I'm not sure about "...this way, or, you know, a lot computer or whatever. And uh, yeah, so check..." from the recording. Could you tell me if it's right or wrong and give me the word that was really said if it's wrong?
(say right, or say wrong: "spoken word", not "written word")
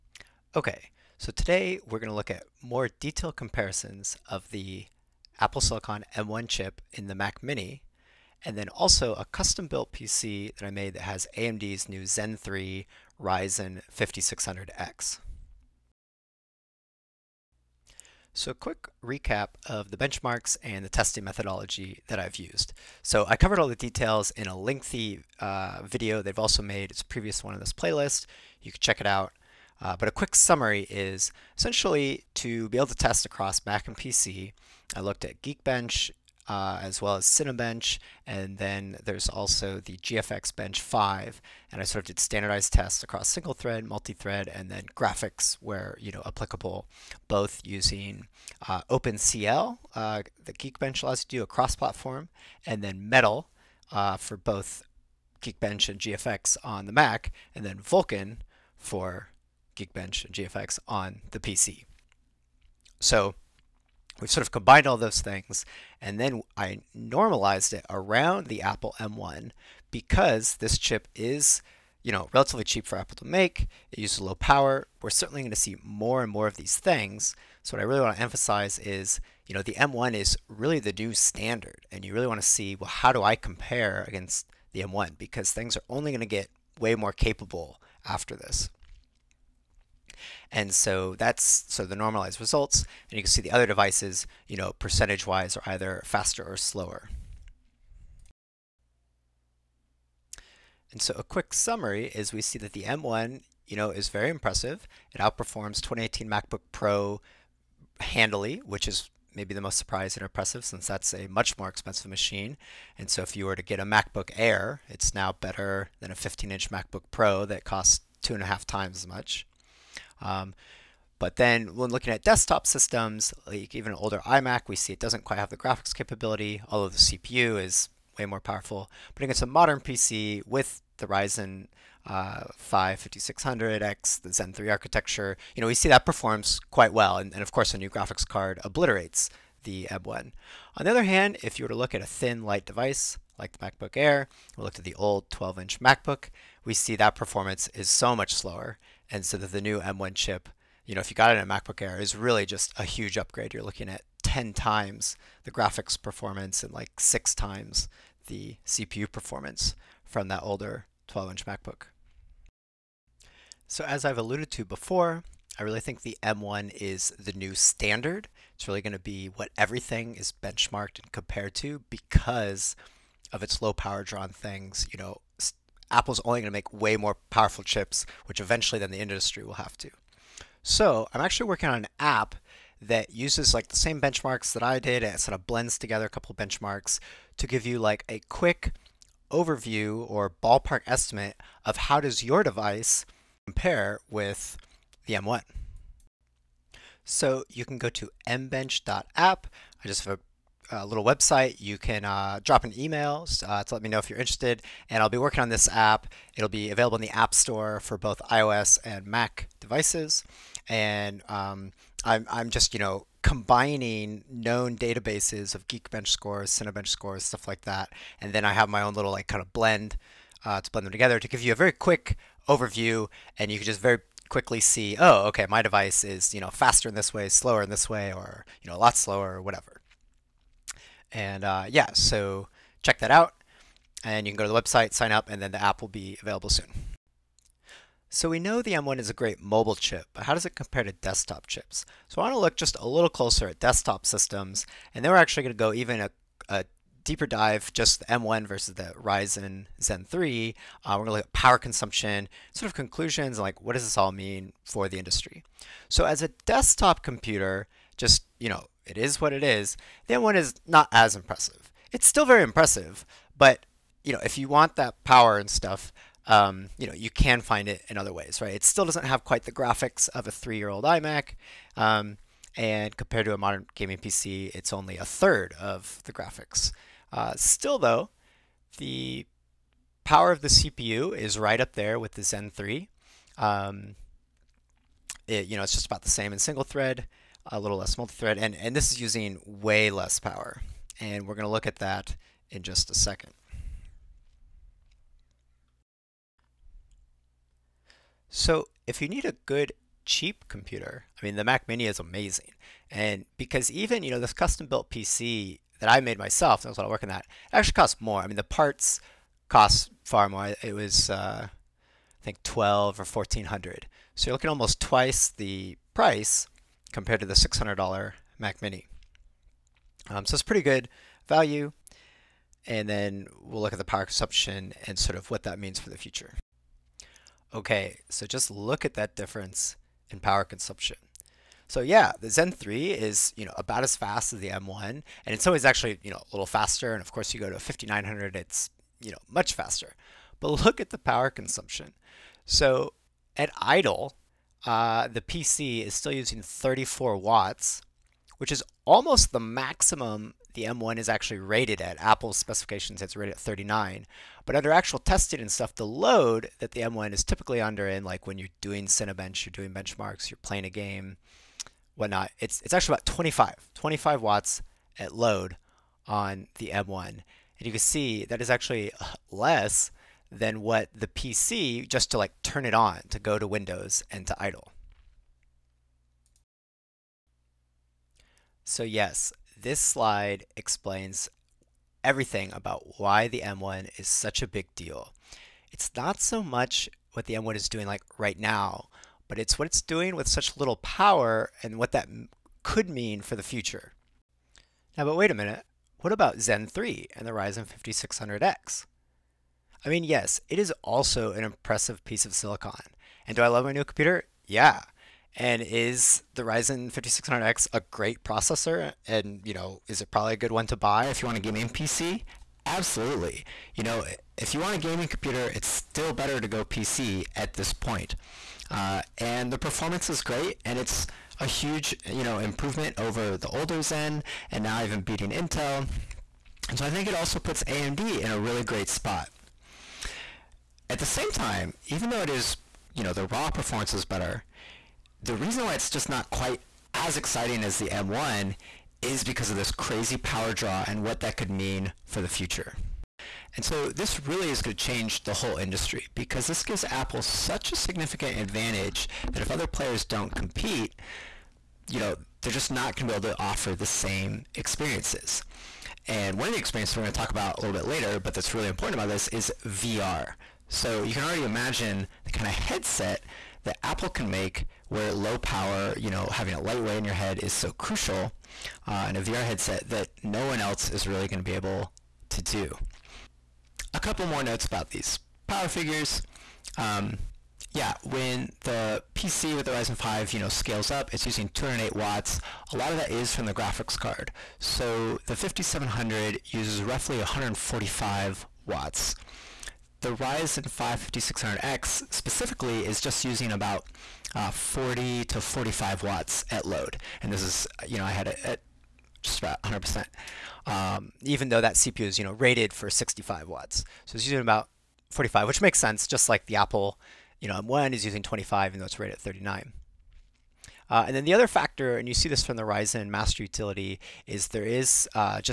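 wrong: "slower", not "computer".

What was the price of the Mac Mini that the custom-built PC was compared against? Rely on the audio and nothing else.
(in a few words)
$600.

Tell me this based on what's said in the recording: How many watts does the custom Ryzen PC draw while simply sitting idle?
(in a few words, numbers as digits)
34 watts.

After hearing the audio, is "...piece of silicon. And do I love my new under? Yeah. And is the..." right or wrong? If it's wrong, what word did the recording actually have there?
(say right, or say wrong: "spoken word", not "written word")
wrong: "computer", not "under".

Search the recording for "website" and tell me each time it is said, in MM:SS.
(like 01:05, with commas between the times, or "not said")
03:21, 03:54.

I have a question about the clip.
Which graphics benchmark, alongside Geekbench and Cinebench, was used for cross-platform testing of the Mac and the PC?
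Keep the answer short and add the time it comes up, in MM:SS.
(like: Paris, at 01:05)
GFX Bench 5, at 00:39.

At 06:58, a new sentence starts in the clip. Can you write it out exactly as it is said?
Uh, and the performance is great, and it's a huge, you know, improvement over the older Zen, and now even beating Intel.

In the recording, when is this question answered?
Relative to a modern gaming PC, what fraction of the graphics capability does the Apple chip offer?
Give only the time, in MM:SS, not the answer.
04:34.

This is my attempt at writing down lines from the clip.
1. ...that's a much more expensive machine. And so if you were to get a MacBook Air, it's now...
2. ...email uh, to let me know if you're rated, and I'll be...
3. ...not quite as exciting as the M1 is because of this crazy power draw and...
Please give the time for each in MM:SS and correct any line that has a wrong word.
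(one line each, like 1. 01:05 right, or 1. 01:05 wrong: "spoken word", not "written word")
1. 01:50 right
2. 03:22 wrong: "interested", not "rated"
3. 07:16 right.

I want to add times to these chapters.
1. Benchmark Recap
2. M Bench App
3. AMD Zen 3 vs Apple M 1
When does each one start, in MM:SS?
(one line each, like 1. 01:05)
1. 00:16
2. 02:42
3. 05:26.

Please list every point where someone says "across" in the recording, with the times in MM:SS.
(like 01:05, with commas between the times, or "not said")
00:33, 00:43.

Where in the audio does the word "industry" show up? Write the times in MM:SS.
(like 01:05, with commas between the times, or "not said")
02:58, 04:14, 07:25.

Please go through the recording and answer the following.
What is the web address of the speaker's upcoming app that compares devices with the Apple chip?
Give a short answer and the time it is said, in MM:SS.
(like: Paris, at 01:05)
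mbench.app, at 03:18.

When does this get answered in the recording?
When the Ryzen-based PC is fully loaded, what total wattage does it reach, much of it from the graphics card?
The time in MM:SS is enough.
08:01.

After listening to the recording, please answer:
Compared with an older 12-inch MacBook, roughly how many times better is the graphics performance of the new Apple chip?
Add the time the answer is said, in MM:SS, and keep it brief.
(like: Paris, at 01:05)
10 times, at 02:34.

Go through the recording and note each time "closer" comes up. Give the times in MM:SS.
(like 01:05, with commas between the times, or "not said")
04:03.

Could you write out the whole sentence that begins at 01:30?
And so that's so the normalized results.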